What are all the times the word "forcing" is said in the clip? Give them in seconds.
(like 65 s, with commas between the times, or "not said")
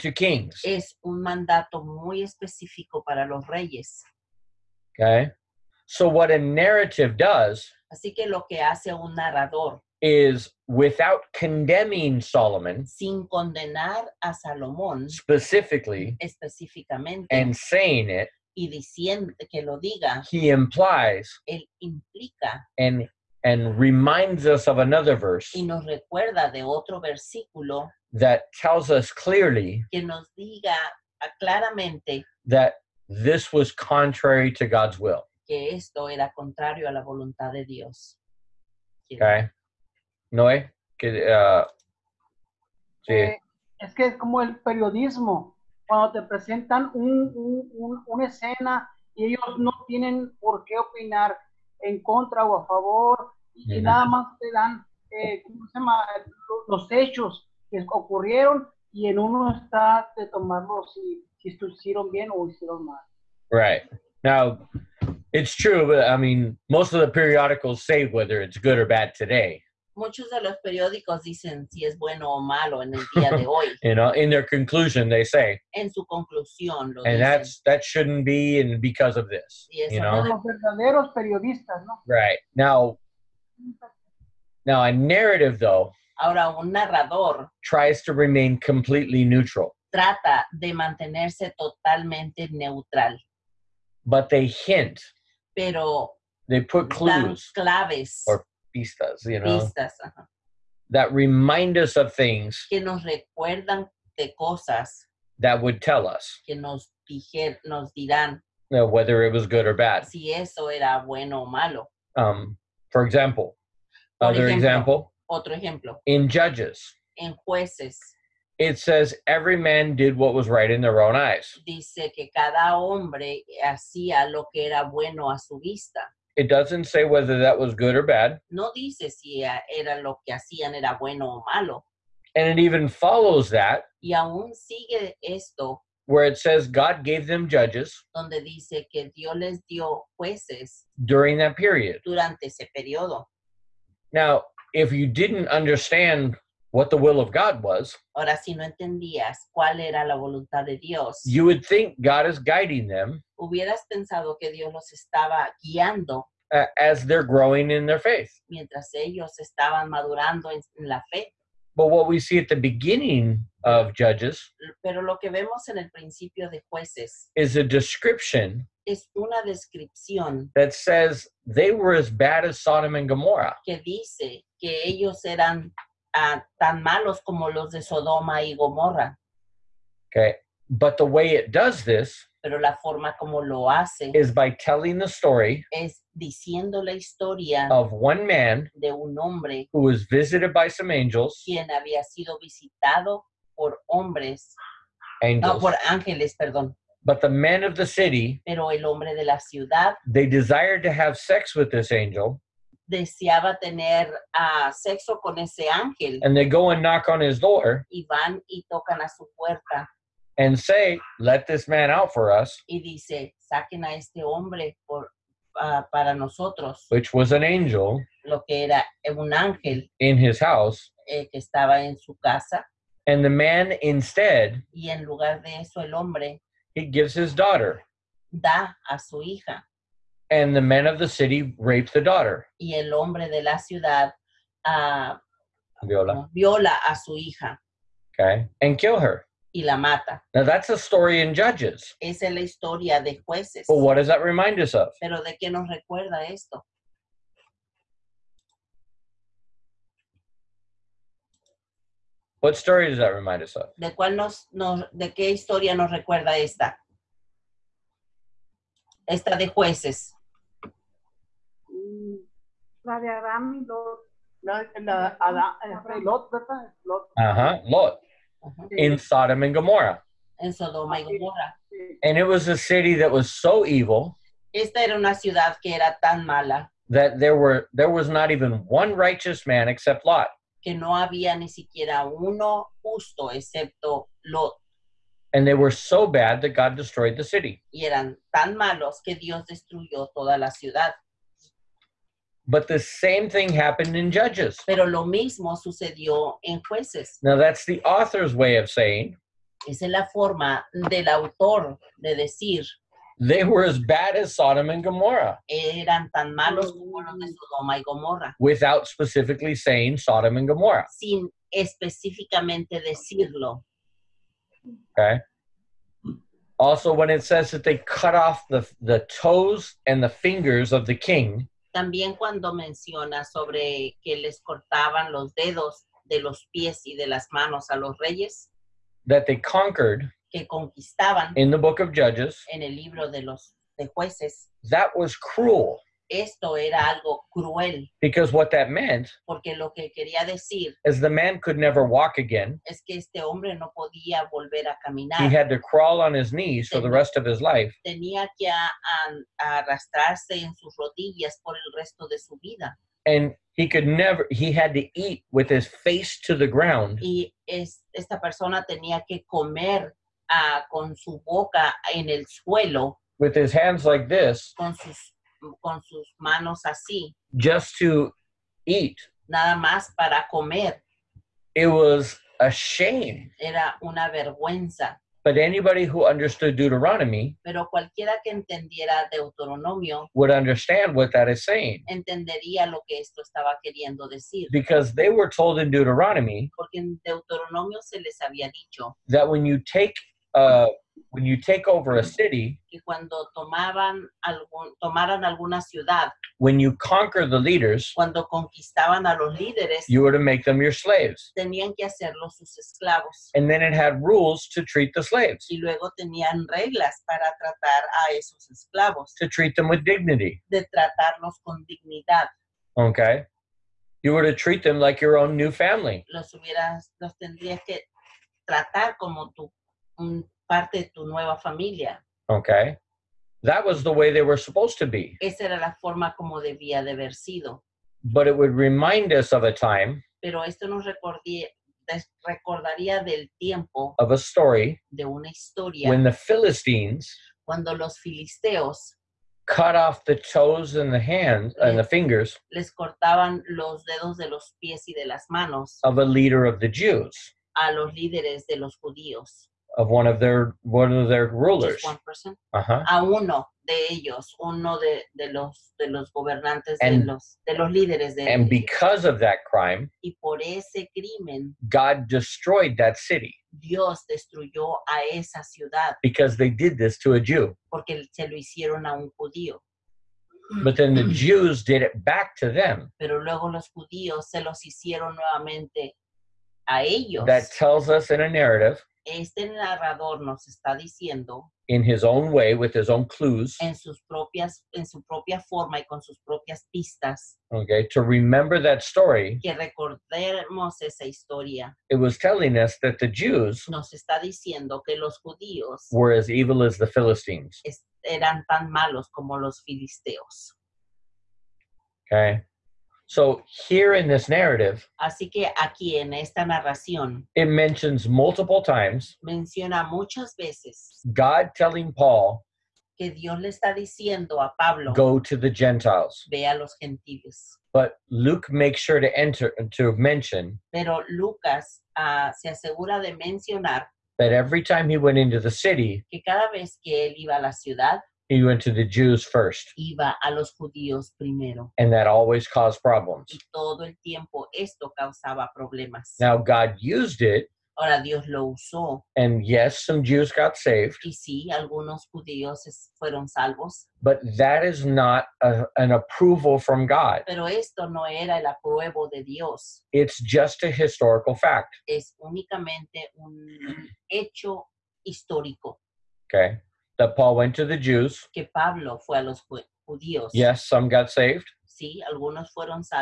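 not said.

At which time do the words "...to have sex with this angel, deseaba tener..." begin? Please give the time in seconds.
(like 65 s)
200 s.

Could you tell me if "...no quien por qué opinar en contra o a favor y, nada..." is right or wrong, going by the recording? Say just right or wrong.
wrong.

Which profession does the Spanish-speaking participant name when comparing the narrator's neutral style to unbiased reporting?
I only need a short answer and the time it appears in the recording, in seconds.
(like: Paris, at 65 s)
Periodismo, at 44 s.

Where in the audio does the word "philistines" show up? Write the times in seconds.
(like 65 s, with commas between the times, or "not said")
436 s, 496 s.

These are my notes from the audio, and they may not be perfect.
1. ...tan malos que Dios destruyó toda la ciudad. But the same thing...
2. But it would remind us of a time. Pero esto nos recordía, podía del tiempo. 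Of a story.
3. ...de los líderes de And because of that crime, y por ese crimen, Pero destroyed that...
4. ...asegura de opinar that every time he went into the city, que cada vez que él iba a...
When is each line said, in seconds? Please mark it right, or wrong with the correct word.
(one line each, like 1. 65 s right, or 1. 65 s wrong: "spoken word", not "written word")
1. 288 s right
2. 428 s wrong: "recordaría", not "podía"
3. 457 s wrong: "God", not "Pero"
4. 522 s wrong: "mencionar", not "opinar".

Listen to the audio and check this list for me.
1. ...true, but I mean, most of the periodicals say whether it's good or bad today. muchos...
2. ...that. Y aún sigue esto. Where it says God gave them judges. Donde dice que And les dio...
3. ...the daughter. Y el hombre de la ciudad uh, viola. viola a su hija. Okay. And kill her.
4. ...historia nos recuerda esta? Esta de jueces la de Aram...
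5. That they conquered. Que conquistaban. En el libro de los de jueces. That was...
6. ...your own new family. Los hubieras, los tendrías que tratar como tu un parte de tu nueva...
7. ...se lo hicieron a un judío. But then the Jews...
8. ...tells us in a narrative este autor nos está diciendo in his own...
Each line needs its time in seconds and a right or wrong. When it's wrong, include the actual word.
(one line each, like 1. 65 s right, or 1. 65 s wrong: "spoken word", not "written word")
1. 65 s right
2. 133 s wrong: "Dios", not "And"
3. 231 s right
4. 255 s right
5. 329 s right
6. 415 s right
7. 468 s right
8. 477 s wrong: "narrador", not "autor".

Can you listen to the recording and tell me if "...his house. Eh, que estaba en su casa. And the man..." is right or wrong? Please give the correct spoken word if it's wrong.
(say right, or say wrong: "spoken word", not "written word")
right.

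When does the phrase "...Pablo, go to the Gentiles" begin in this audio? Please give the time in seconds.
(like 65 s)
514 s.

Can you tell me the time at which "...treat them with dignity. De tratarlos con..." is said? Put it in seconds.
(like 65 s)
409 s.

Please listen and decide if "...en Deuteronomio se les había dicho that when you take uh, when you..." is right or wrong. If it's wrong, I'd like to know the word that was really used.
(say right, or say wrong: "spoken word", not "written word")
right.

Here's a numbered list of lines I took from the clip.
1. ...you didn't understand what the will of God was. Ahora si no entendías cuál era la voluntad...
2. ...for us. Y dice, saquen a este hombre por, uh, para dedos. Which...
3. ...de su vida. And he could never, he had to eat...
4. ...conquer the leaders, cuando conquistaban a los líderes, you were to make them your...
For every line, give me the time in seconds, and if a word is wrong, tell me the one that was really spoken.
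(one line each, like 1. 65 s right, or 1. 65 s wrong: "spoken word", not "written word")
1. 144 s right
2. 212 s wrong: "nosotros", not "dedos"
3. 352 s right
4. 396 s right.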